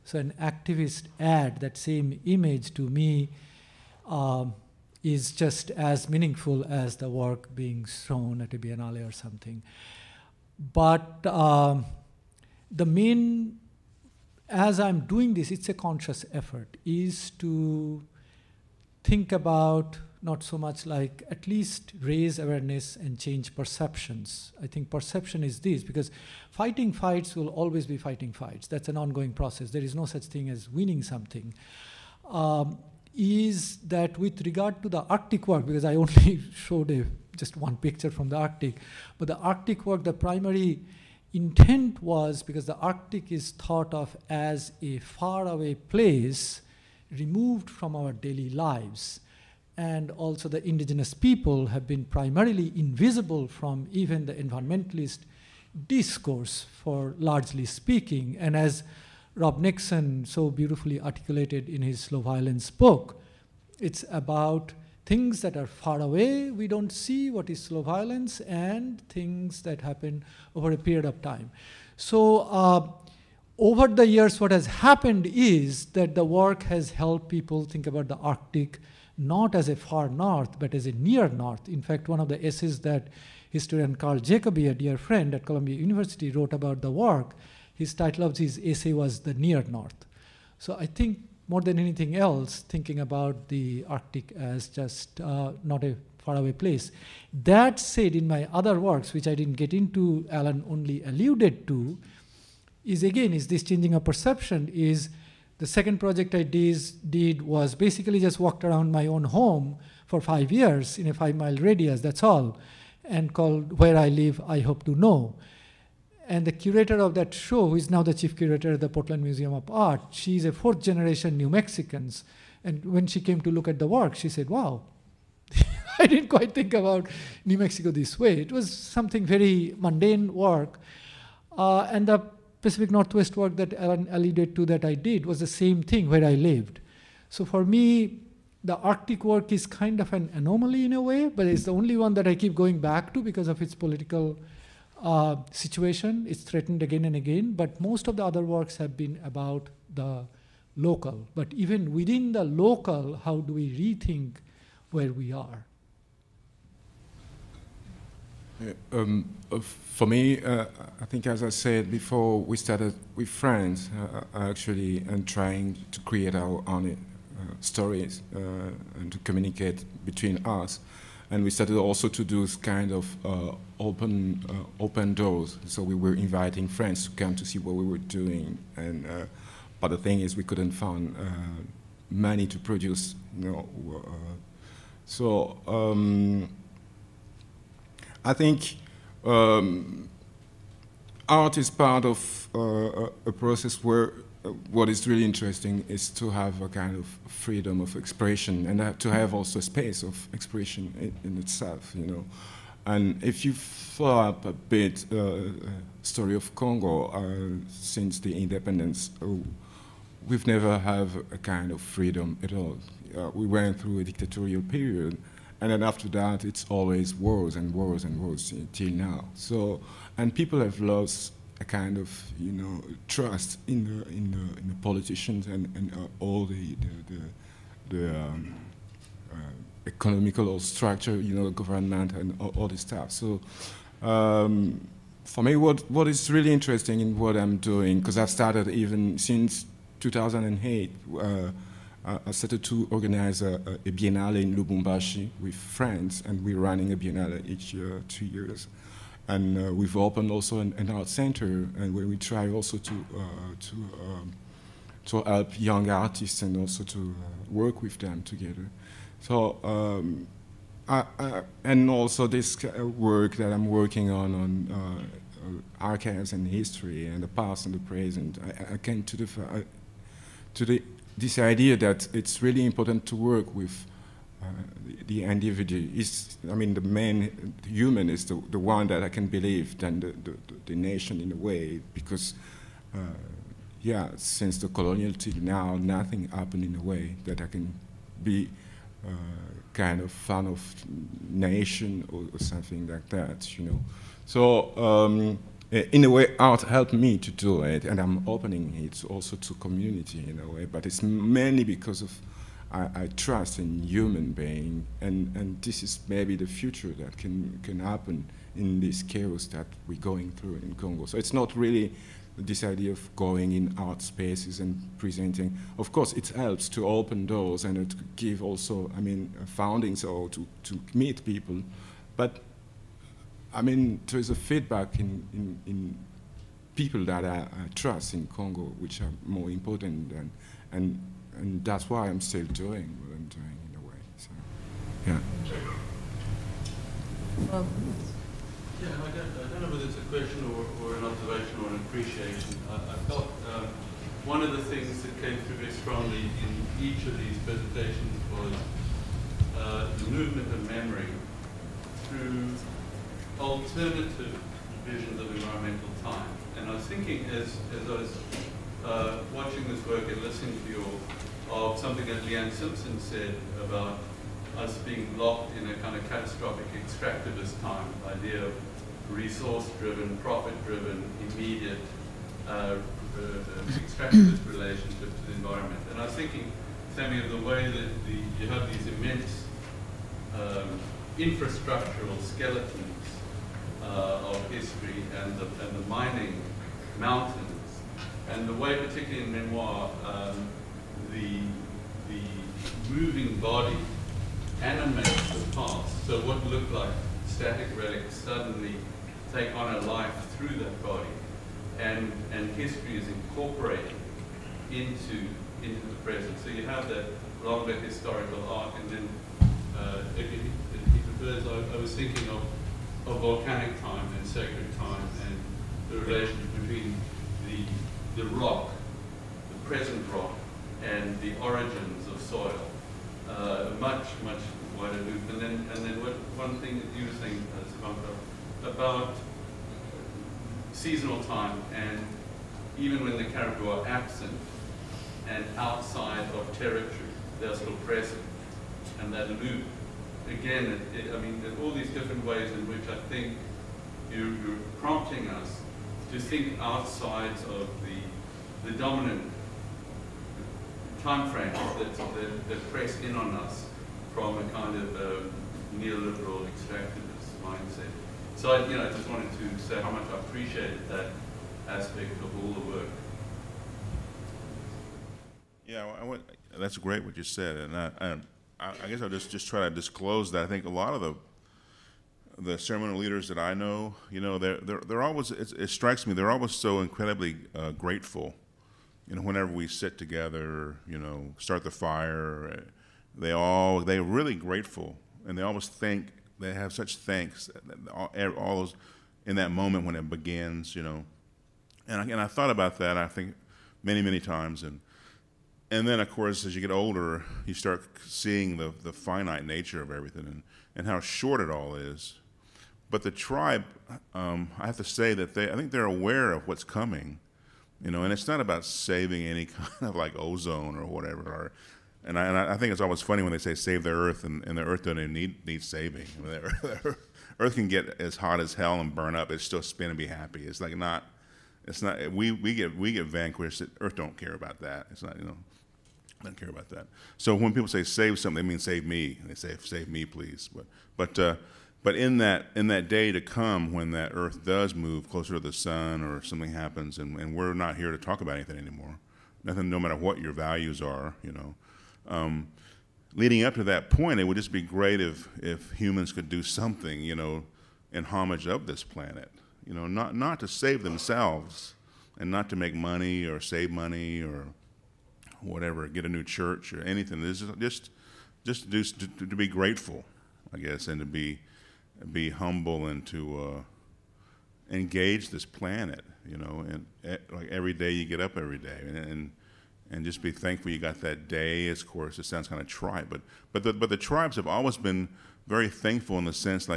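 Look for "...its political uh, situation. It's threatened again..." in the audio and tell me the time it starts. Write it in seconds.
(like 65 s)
143 s.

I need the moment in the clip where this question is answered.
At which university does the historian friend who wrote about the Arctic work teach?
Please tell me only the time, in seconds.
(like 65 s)
85 s.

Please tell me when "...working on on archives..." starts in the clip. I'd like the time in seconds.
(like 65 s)
263 s.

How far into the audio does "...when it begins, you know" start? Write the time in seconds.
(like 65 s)
489 s.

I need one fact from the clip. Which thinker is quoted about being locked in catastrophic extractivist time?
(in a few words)
Leanne Simpson.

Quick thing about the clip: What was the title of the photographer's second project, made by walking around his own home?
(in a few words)
Where I Live, I Hope to Know.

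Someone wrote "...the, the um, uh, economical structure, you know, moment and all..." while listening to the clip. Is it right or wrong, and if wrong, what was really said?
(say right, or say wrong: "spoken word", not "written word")
wrong: "government", not "moment".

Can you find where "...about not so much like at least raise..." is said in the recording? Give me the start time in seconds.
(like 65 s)
19 s.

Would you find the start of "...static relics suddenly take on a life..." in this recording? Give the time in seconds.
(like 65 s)
397 s.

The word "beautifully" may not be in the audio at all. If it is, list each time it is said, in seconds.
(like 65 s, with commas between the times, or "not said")
60 s.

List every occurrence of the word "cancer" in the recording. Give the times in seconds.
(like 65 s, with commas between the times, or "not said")
not said.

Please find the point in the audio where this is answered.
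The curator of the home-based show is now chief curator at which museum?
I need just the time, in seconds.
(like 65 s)
118 s.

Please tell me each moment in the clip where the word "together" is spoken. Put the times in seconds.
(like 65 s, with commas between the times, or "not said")
258 s, 479 s.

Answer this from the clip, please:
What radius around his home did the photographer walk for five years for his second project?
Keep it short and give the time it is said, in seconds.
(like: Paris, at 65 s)
5 miles, at 111 s.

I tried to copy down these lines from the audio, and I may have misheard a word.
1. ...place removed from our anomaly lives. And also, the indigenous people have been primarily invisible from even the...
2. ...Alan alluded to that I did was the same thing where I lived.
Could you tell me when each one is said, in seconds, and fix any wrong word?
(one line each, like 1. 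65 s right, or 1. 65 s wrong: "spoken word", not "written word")
1. 45 s wrong: "daily", not "anomaly"
2. 133 s right.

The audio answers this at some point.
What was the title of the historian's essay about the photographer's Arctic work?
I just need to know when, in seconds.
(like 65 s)
89 s.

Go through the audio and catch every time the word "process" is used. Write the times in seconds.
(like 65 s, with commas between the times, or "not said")
29 s, 193 s.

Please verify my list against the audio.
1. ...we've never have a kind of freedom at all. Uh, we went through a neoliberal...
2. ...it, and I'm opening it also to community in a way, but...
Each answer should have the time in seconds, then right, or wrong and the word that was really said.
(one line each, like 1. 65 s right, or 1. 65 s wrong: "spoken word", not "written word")
1. 210 s wrong: "dictatorial", not "neoliberal"
2. 297 s right.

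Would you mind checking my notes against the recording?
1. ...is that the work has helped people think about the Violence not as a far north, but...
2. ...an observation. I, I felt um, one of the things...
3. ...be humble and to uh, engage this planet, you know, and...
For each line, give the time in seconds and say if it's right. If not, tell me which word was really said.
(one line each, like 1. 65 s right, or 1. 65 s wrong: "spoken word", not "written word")
1. 75 s wrong: "Arctic", not "Violence"
2. 341 s wrong: "appreciation", not "observation"
3. 562 s right.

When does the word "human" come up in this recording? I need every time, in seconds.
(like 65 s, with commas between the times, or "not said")
277 s, 303 s, 545 s.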